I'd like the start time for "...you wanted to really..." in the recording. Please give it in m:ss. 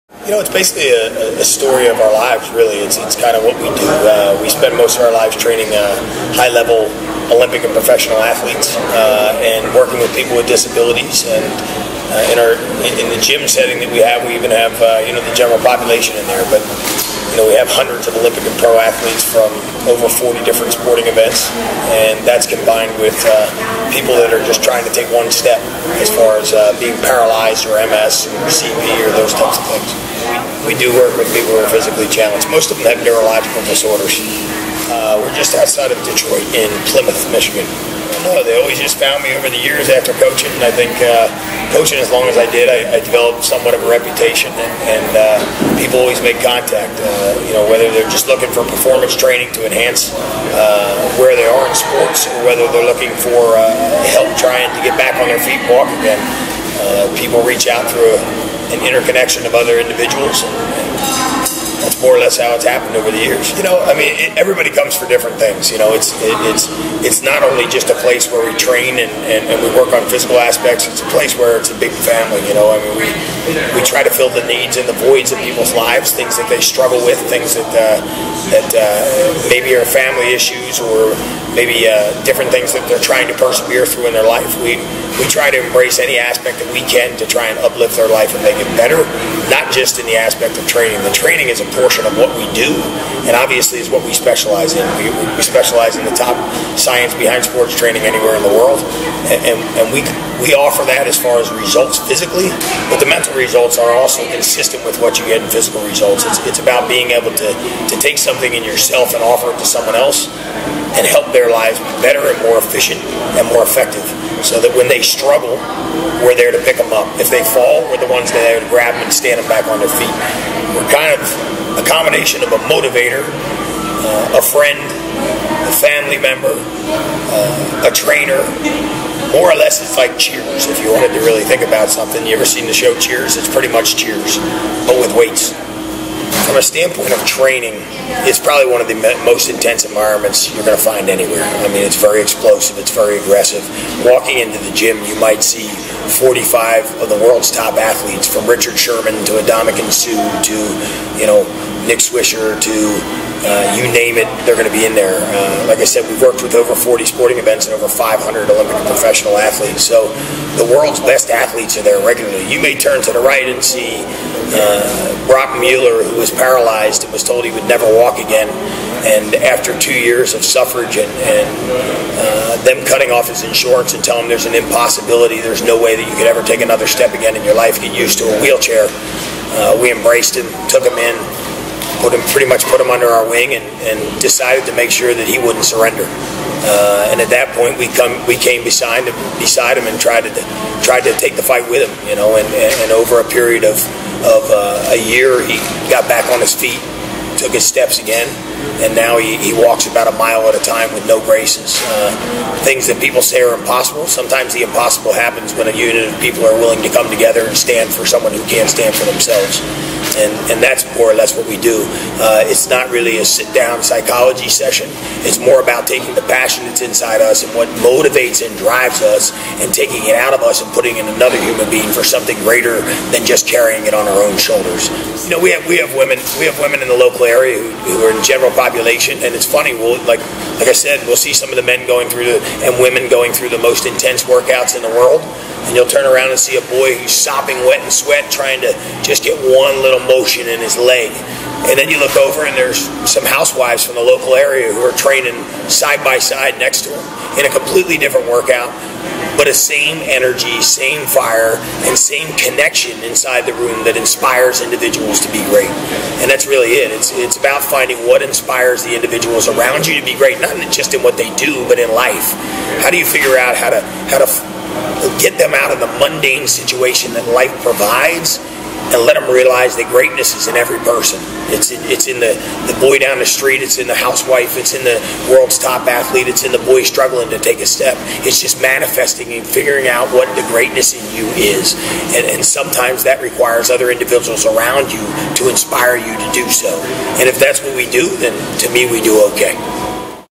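2:10.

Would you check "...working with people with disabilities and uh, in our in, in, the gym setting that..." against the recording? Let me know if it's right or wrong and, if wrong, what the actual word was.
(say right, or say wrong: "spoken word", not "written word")
right.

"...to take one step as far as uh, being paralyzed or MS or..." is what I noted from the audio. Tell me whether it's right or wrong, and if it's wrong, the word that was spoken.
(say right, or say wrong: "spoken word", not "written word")
right.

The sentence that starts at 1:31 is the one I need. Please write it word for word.
The training is a portion of what we do, and obviously is what we specialize in.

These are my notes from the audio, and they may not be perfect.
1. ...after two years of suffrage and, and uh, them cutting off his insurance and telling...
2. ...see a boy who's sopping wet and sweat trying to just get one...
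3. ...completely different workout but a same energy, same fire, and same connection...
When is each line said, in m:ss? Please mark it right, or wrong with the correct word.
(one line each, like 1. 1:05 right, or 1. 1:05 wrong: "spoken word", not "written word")
1. 2:49 right
2. 3:56 right
3. 4:07 right.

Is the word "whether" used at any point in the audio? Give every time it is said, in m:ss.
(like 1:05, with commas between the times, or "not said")
0:47, 0:52.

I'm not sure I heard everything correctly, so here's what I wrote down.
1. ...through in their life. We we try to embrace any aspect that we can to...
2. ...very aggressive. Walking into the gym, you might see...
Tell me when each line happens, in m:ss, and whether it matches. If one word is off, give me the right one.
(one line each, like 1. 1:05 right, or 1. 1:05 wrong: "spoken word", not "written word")
1. 1:23 right
2. 2:22 right.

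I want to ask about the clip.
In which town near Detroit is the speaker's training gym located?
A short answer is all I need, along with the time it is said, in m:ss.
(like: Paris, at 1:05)
Plymouth, Michigan, at 0:36.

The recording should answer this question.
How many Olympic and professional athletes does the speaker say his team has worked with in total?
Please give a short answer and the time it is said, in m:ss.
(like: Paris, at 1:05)
500, at 2:37.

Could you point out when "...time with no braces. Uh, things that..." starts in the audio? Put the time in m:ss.
3:20.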